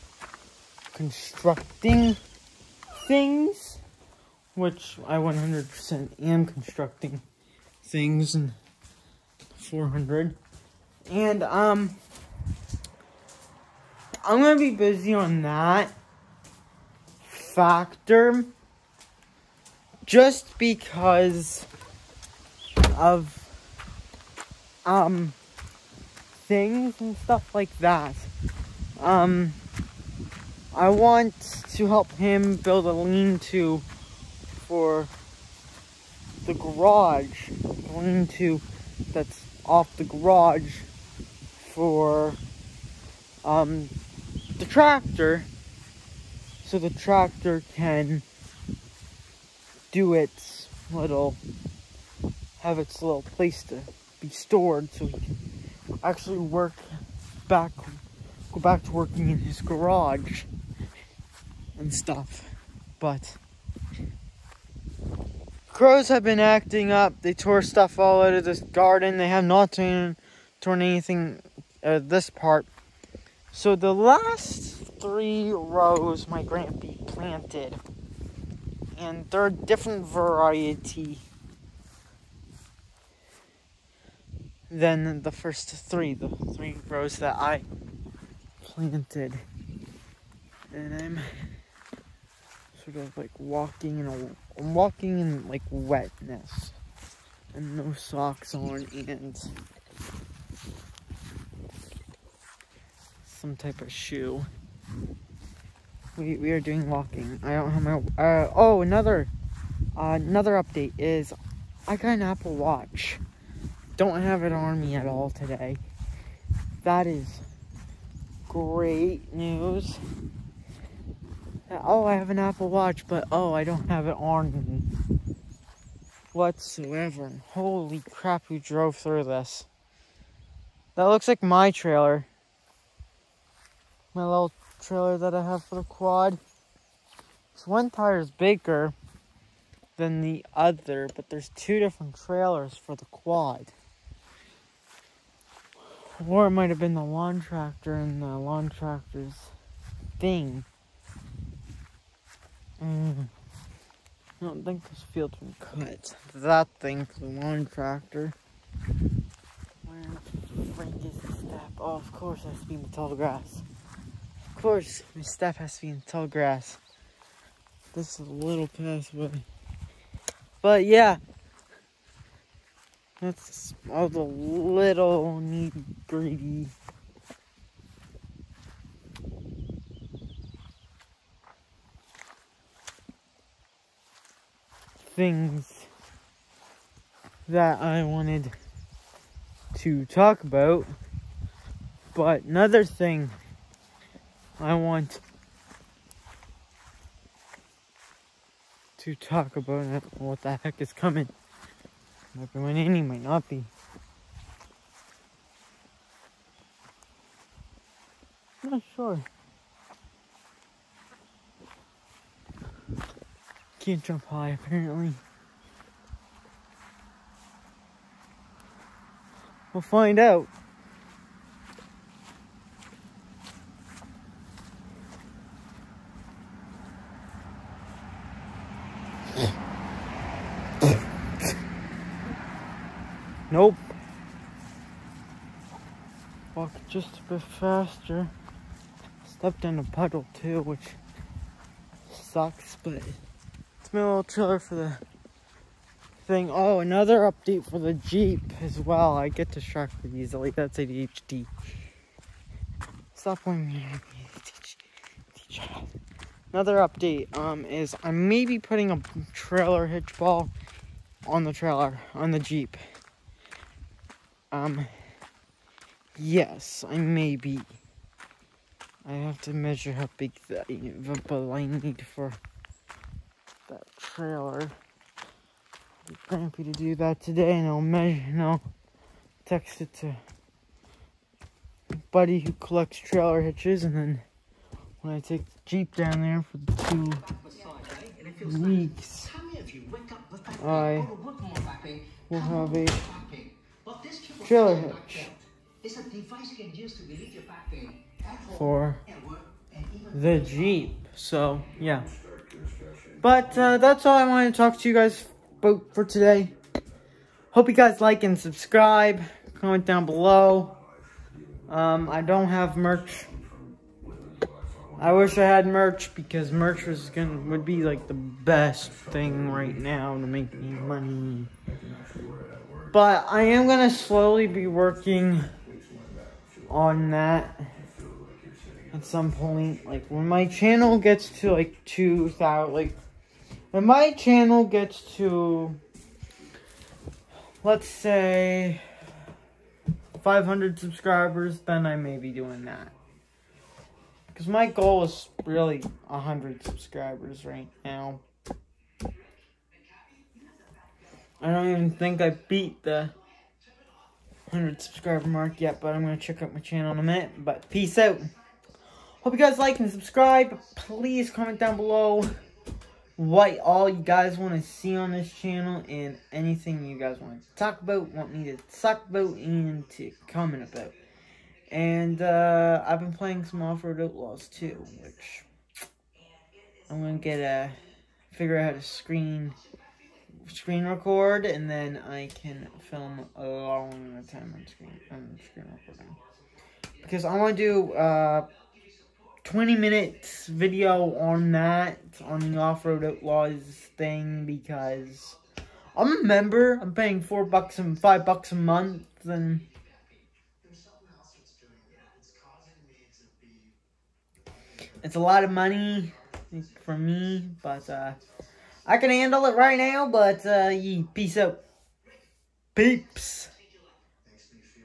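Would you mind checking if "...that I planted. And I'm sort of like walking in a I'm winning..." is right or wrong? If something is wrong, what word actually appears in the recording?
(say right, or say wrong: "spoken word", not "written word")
wrong: "walking", not "winning".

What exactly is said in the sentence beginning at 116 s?
That is great news oh, I have an Apple Watch, but oh, I don't have it on whatsoever.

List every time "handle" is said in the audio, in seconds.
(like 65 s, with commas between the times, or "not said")
409 s.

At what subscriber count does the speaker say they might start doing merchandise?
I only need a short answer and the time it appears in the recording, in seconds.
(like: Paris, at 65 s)
500, at 340 s.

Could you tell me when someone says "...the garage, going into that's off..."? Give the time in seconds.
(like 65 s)
36 s.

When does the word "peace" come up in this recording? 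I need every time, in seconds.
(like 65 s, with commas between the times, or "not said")
357 s, 411 s.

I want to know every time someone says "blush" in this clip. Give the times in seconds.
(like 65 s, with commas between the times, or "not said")
not said.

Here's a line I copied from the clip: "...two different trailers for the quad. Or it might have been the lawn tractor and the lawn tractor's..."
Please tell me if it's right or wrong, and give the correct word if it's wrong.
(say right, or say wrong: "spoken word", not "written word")
right.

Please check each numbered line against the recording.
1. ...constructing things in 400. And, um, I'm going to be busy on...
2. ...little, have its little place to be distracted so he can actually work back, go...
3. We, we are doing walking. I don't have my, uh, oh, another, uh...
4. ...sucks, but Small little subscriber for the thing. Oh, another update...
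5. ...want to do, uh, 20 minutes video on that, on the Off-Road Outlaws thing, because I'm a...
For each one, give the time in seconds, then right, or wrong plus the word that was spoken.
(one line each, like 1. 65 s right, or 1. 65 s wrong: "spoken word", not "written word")
1. 6 s right
2. 50 s wrong: "stored", not "distracted"
3. 106 s right
4. 242 s wrong: "trailer", not "subscriber"
5. 387 s right.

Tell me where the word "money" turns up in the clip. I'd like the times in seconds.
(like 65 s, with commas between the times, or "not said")
320 s, 405 s.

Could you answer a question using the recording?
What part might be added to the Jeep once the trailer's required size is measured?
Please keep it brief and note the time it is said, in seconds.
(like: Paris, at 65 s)
trailer hitch ball, at 259 s.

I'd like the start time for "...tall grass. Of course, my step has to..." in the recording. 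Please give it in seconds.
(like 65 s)
162 s.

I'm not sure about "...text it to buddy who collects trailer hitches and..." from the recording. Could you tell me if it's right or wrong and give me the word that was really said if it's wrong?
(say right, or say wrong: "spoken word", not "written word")
right.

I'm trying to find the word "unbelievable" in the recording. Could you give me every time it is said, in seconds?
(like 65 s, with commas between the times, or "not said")
not said.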